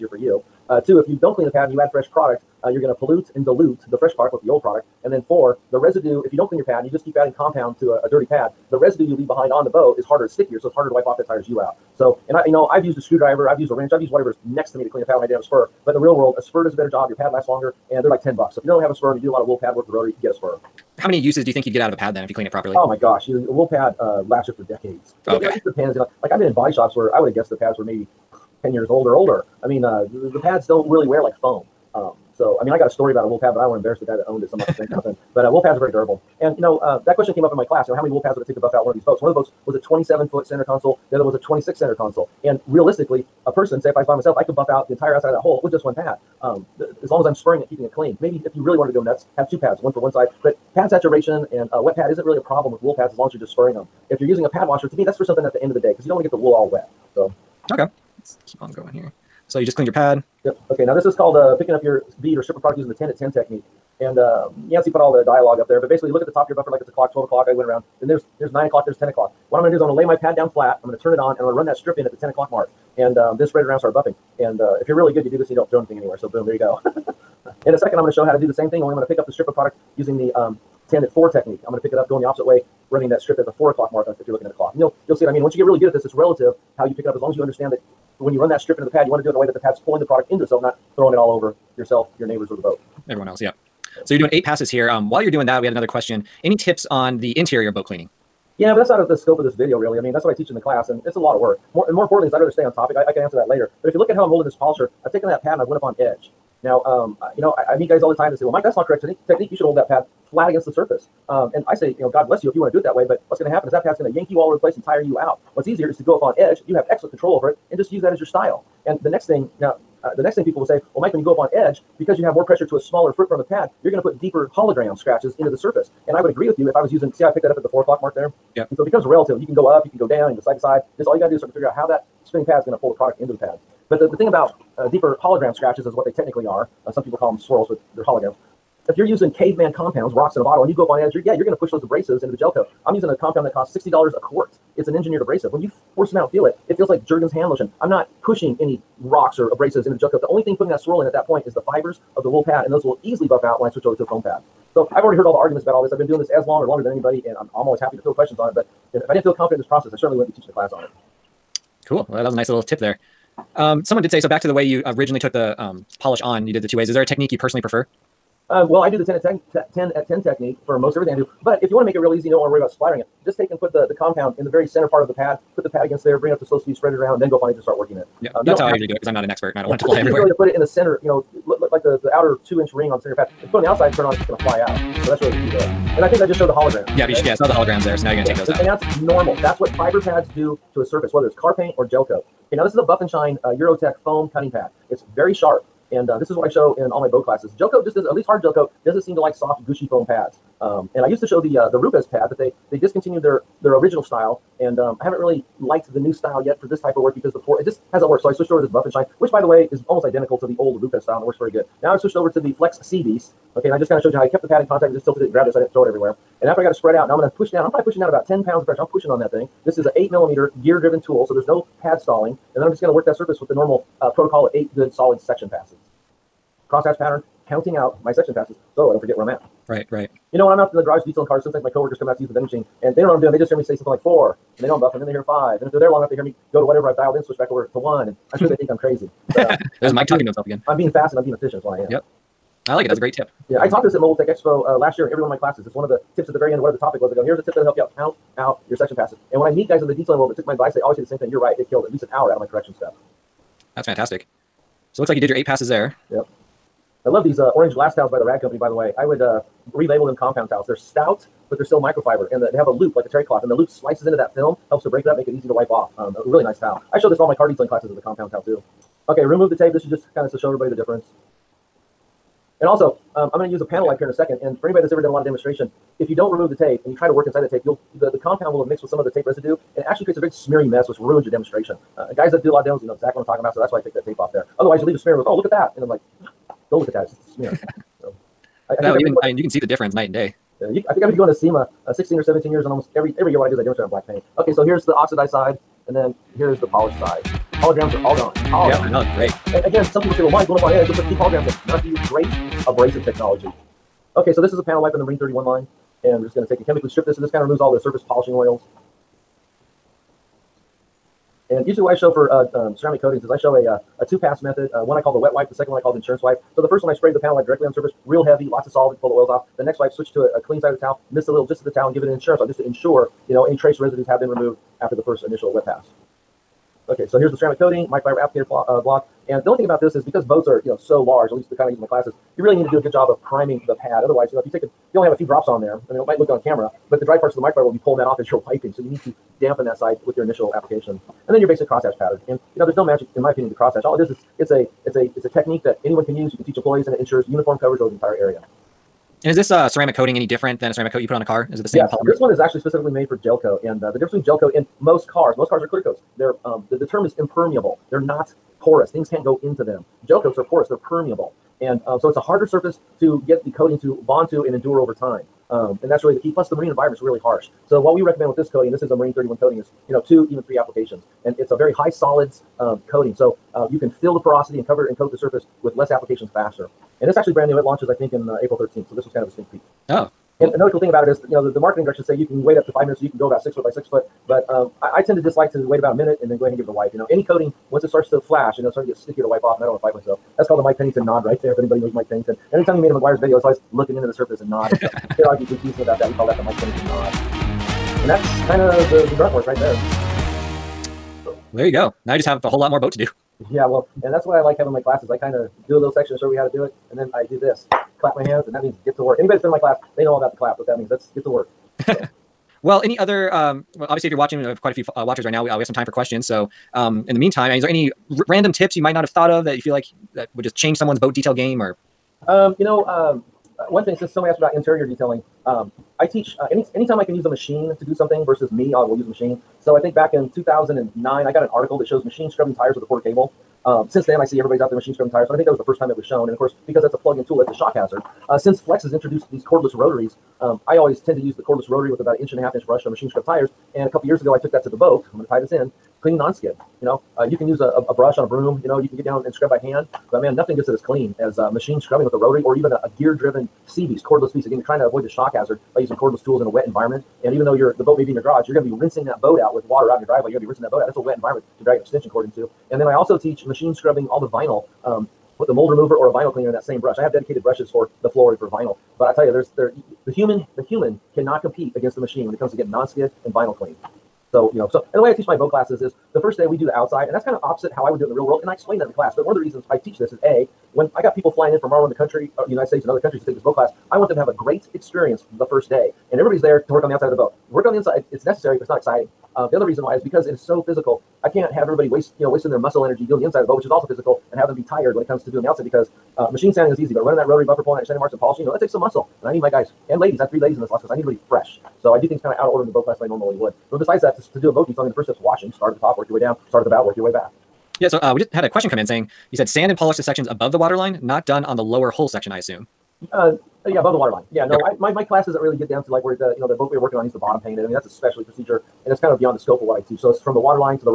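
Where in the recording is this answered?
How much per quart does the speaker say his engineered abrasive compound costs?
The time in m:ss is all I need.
2:23.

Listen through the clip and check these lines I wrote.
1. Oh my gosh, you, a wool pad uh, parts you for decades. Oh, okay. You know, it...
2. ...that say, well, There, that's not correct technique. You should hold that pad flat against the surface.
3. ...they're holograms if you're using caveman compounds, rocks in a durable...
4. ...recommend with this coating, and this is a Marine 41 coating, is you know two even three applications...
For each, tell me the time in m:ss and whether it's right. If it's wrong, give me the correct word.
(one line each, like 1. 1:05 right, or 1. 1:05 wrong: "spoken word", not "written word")
1. 0:22 wrong: "lasts", not "parts"
2. 1:48 wrong: "Mike", not "There"
3. 2:17 wrong: "bottle", not "durable"
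4. 6:08 wrong: "31", not "41".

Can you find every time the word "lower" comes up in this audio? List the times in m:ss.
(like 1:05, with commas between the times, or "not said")
8:31.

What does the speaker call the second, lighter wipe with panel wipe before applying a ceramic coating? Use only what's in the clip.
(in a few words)
insurance wipe.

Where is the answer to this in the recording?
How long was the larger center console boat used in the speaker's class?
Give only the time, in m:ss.
0:39.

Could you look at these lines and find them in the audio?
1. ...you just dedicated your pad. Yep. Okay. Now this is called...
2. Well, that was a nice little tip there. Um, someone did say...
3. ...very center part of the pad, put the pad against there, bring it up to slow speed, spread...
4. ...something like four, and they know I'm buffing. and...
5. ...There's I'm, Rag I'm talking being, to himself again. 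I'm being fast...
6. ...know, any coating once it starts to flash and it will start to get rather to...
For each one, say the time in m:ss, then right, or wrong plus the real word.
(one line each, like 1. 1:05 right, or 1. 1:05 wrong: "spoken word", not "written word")
1. 0:59 wrong: "cleaned", not "dedicated"
2. 2:42 right
3. 2:54 right
4. 3:53 right
5. 3:59 wrong: "Mike", not "Rag"
6. 6:26 wrong: "stickier", not "rather".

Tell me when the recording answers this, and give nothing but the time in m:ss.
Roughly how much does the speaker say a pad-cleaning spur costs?
0:18.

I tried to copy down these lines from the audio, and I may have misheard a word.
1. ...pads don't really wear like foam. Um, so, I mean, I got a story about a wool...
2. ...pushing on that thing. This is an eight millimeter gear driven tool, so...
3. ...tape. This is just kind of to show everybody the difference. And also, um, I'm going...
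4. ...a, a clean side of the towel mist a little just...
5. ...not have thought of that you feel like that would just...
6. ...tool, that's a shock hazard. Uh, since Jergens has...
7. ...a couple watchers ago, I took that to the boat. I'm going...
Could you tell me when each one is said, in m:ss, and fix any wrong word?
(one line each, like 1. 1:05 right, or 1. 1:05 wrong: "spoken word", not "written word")
1. 0:30 right
2. 3:38 right
3. 4:29 right
4. 5:20 right
5. 6:58 right
6. 7:17 wrong: "Flex", not "Jergens"
7. 7:23 wrong: "years", not "watchers".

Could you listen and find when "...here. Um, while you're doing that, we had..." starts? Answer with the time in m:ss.
1:34.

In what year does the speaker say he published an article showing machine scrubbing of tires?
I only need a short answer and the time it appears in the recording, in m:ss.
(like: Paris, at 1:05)
2009, at 7:10.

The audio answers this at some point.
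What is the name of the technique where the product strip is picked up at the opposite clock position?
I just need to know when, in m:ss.
1:20.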